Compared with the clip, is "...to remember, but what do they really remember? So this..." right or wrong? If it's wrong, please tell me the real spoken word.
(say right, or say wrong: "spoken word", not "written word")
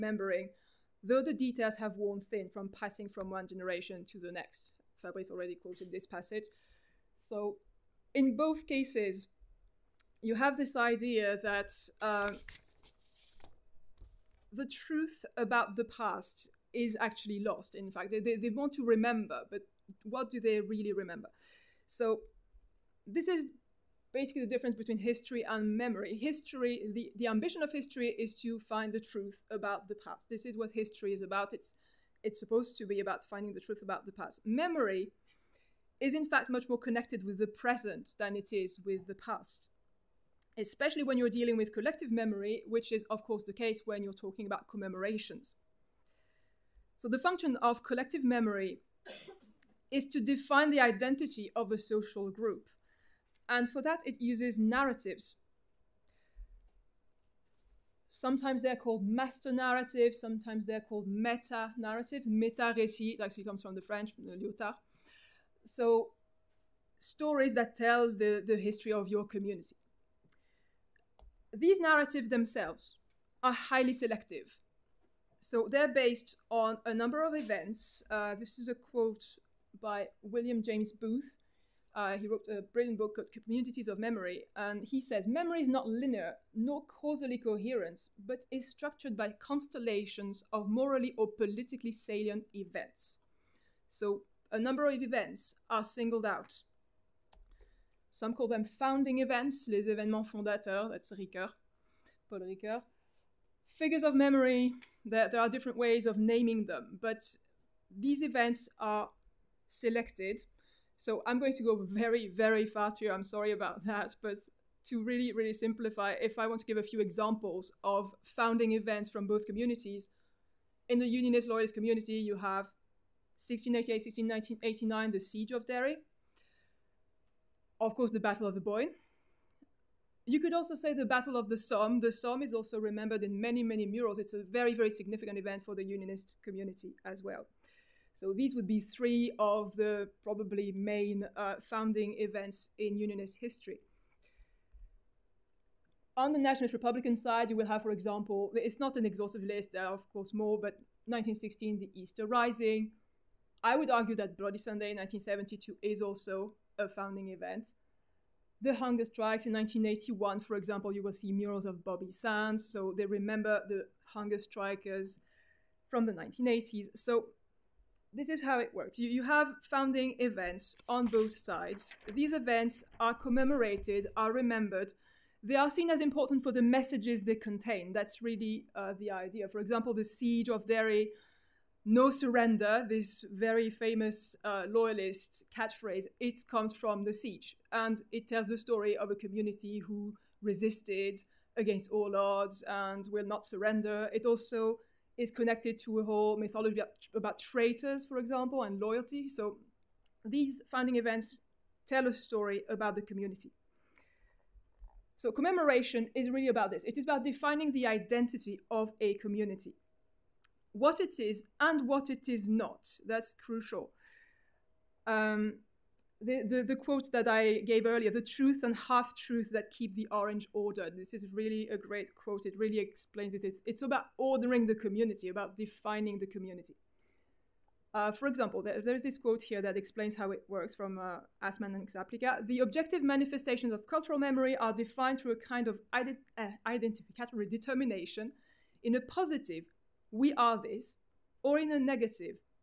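right.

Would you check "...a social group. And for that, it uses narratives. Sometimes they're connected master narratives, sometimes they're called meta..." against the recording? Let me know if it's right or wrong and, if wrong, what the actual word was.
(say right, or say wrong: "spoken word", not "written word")
wrong: "called", not "connected".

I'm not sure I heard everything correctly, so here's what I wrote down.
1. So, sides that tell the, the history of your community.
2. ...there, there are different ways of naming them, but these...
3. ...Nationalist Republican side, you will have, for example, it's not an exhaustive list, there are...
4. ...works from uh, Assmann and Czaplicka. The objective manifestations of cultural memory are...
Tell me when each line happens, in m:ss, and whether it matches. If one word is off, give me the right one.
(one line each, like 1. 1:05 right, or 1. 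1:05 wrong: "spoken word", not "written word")
1. 1:05 wrong: "stories", not "sides"
2. 1:45 right
3. 2:26 right
4. 3:50 right.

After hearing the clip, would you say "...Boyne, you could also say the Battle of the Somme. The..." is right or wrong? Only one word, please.
right.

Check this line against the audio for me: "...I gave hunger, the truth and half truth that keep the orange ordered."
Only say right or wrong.
wrong.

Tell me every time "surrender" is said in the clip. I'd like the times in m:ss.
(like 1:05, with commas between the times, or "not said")
3:02, 3:13.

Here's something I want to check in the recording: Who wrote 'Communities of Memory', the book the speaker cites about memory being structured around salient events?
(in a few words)
William James Booth.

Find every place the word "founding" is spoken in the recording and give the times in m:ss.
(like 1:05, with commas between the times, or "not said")
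1:38, 1:58, 2:21, 2:36, 2:49, 3:20.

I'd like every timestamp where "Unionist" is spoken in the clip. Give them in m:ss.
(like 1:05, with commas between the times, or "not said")
2:01, 2:15, 2:22.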